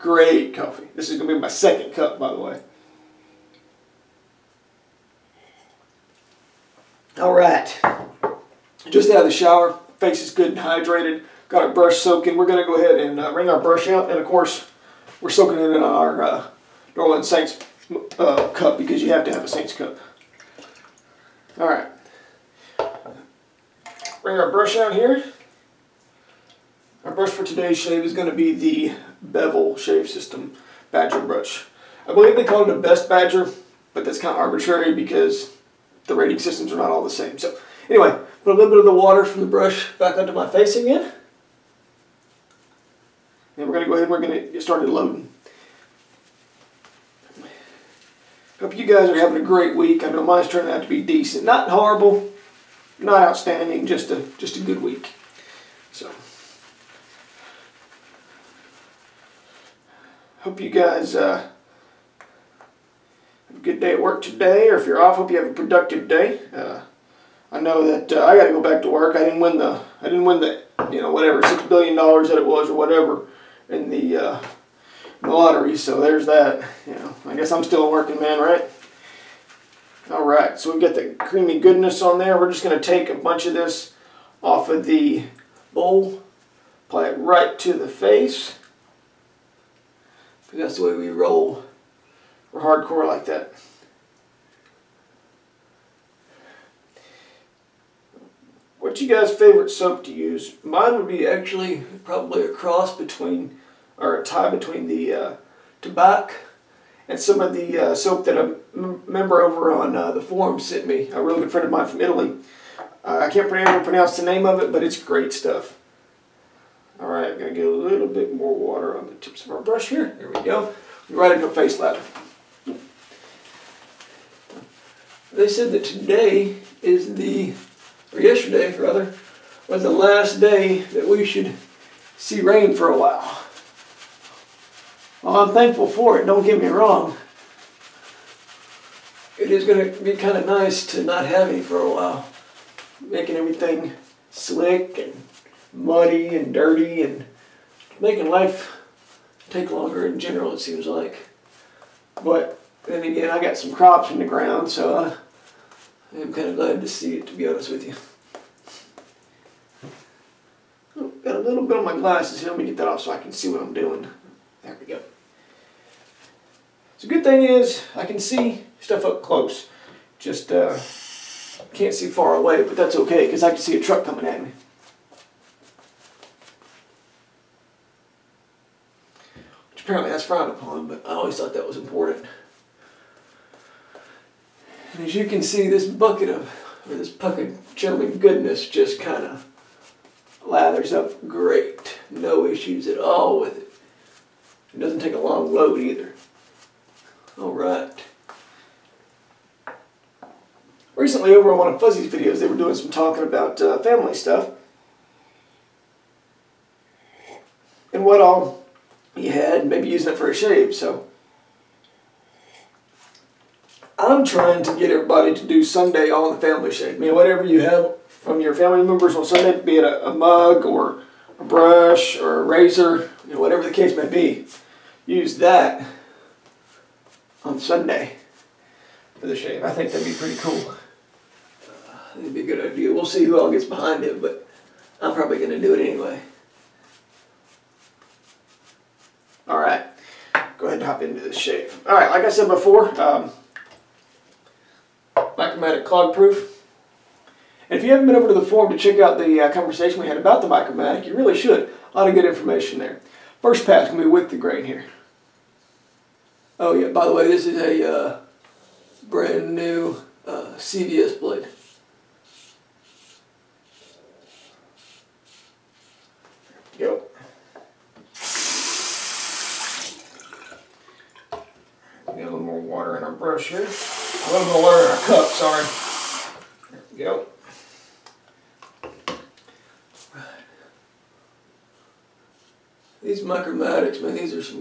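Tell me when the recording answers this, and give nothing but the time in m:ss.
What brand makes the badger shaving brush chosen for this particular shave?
0:29.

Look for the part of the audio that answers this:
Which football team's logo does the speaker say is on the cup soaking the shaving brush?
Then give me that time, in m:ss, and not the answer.
0:16.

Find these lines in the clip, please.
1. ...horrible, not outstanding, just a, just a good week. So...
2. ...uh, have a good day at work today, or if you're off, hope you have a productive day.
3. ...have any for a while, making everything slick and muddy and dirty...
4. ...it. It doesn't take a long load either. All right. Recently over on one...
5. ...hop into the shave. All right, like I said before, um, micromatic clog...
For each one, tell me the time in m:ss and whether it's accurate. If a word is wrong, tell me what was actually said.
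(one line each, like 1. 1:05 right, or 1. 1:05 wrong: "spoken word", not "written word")
1. 0:51 right
2. 1:01 right
3. 2:21 right
4. 3:13 right
5. 4:00 right.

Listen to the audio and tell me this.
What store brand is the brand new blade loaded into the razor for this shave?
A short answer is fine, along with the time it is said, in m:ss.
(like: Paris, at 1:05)
CVS, at 4:20.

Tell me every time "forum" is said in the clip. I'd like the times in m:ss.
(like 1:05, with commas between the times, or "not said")
1:50, 4:08.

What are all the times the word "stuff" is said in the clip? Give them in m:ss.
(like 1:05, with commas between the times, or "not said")
1:55, 2:48, 3:24.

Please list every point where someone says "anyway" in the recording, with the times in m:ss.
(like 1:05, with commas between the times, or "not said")
0:37, 3:55.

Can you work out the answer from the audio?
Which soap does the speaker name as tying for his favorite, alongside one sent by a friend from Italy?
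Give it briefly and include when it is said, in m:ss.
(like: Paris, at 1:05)
Tabac, at 1:45.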